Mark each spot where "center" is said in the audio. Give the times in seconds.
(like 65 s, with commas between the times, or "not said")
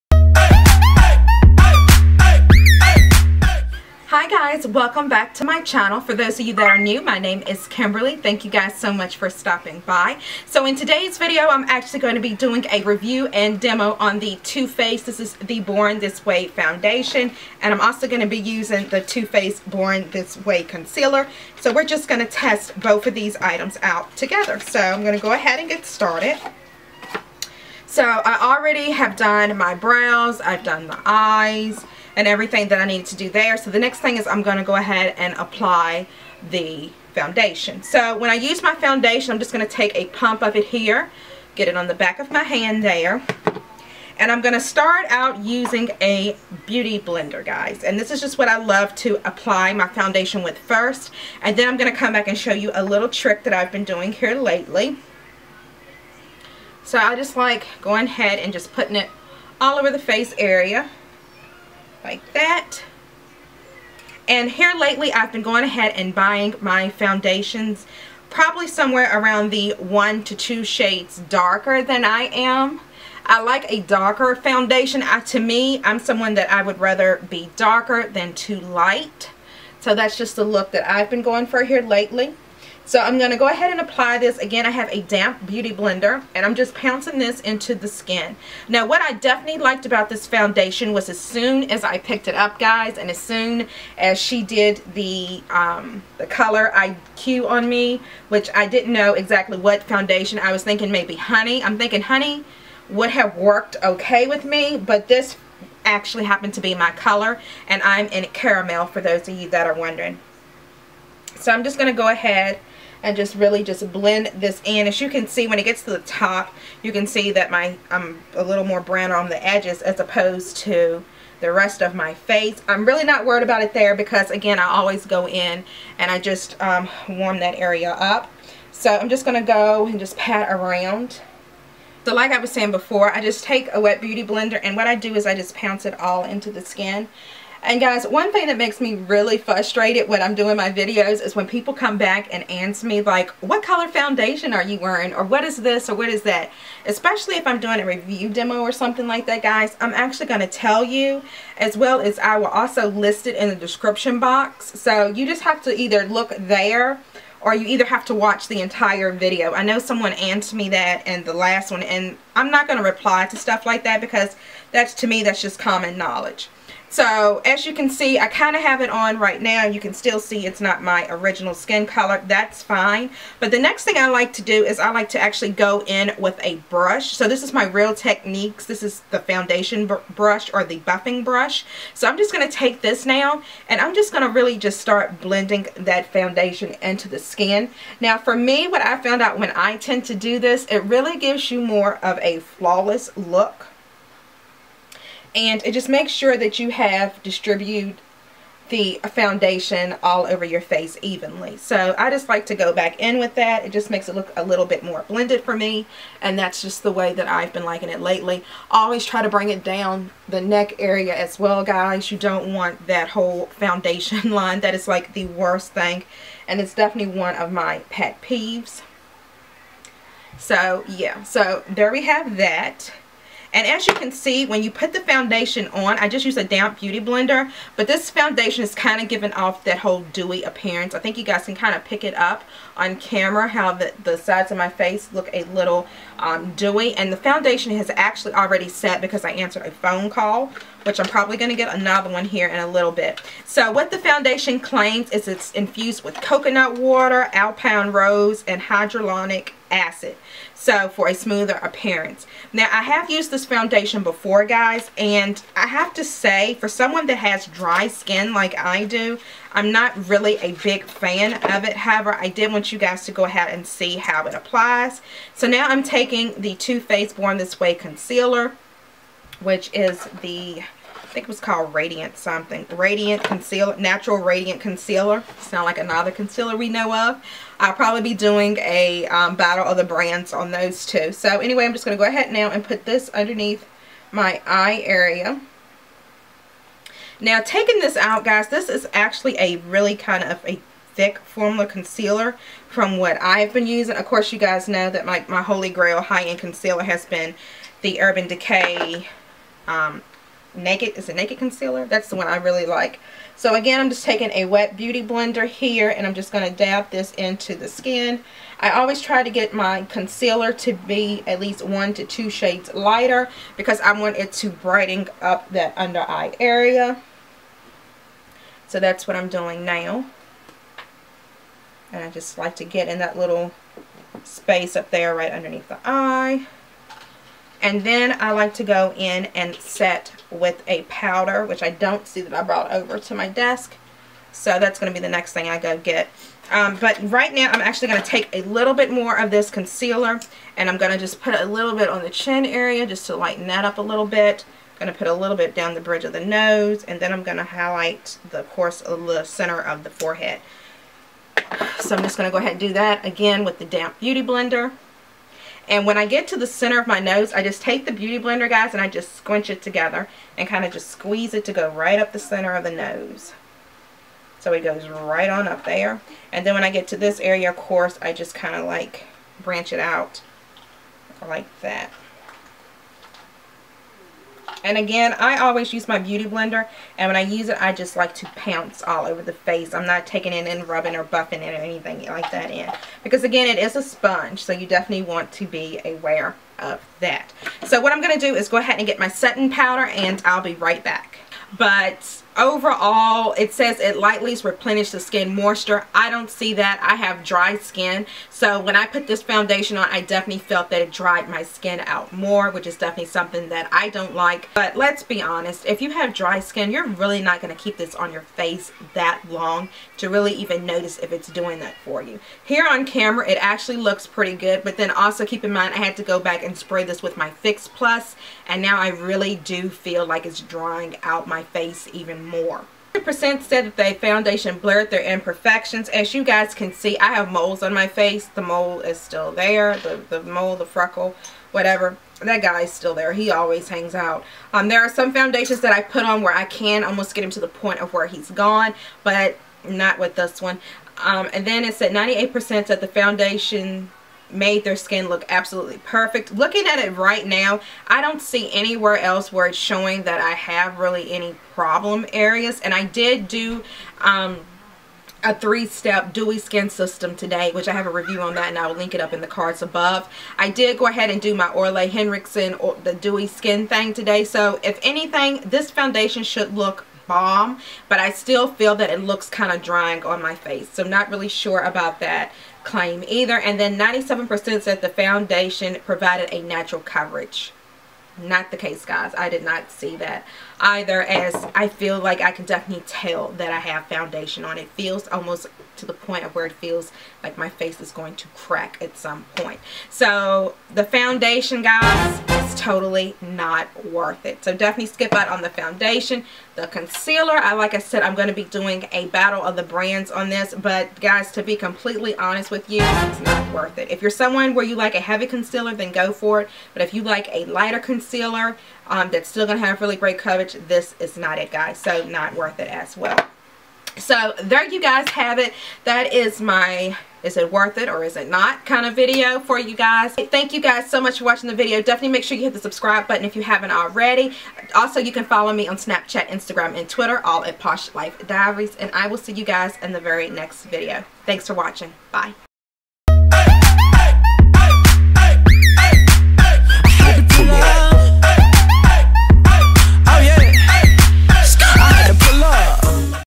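349 s, 356 s, 362 s.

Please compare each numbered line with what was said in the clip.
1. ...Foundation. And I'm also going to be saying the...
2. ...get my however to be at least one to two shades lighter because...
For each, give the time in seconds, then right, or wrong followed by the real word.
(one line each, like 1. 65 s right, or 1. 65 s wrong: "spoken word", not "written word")
1. 16 s wrong: "using", not "saying"
2. 309 s wrong: "concealer", not "however".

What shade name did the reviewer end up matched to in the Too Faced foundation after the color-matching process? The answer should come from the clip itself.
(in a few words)
Caramel.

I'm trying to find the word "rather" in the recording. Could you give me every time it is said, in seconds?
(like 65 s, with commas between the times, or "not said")
76 s.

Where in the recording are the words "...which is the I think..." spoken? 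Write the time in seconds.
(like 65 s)
269 s.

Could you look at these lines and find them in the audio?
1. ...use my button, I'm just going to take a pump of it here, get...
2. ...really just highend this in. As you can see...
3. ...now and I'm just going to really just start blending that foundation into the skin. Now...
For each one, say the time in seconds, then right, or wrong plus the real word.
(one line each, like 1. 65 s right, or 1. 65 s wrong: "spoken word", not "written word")
1. 38 s wrong: "foundation", not "button"
2. 113 s wrong: "blend", not "highend"
3. 183 s right.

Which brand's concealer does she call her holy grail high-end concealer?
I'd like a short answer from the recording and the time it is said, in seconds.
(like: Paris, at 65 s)
Urban Decay, at 297 s.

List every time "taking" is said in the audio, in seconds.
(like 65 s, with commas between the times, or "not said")
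265 s, 287 s, 304 s, 380 s.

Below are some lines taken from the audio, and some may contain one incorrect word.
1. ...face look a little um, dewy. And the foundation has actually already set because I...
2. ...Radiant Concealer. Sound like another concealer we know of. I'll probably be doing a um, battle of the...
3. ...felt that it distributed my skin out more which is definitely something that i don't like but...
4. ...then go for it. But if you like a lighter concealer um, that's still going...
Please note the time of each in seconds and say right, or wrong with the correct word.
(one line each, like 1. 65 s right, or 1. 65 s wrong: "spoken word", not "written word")
1. 234 s right
2. 274 s right
3. 400 s wrong: "dried", not "distributed"
4. 505 s right.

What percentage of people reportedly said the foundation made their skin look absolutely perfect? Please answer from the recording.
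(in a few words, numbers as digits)
98%.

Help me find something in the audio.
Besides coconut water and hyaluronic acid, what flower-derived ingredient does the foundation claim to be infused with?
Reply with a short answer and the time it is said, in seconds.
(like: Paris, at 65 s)
Alpine Rose, at 247 s.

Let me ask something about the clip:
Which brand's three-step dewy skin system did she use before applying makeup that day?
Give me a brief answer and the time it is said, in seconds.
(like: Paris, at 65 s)
Ole Henriksen, at 461 s.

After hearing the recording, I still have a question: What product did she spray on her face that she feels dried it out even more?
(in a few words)
Fix Plus.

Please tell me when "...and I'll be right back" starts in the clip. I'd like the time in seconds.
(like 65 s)
389 s.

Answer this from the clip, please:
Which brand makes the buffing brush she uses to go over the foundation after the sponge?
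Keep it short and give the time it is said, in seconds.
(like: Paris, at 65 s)
Real Techniques, at 177 s.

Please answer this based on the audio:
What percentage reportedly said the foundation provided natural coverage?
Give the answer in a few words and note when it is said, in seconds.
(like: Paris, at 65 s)
97%, at 473 s.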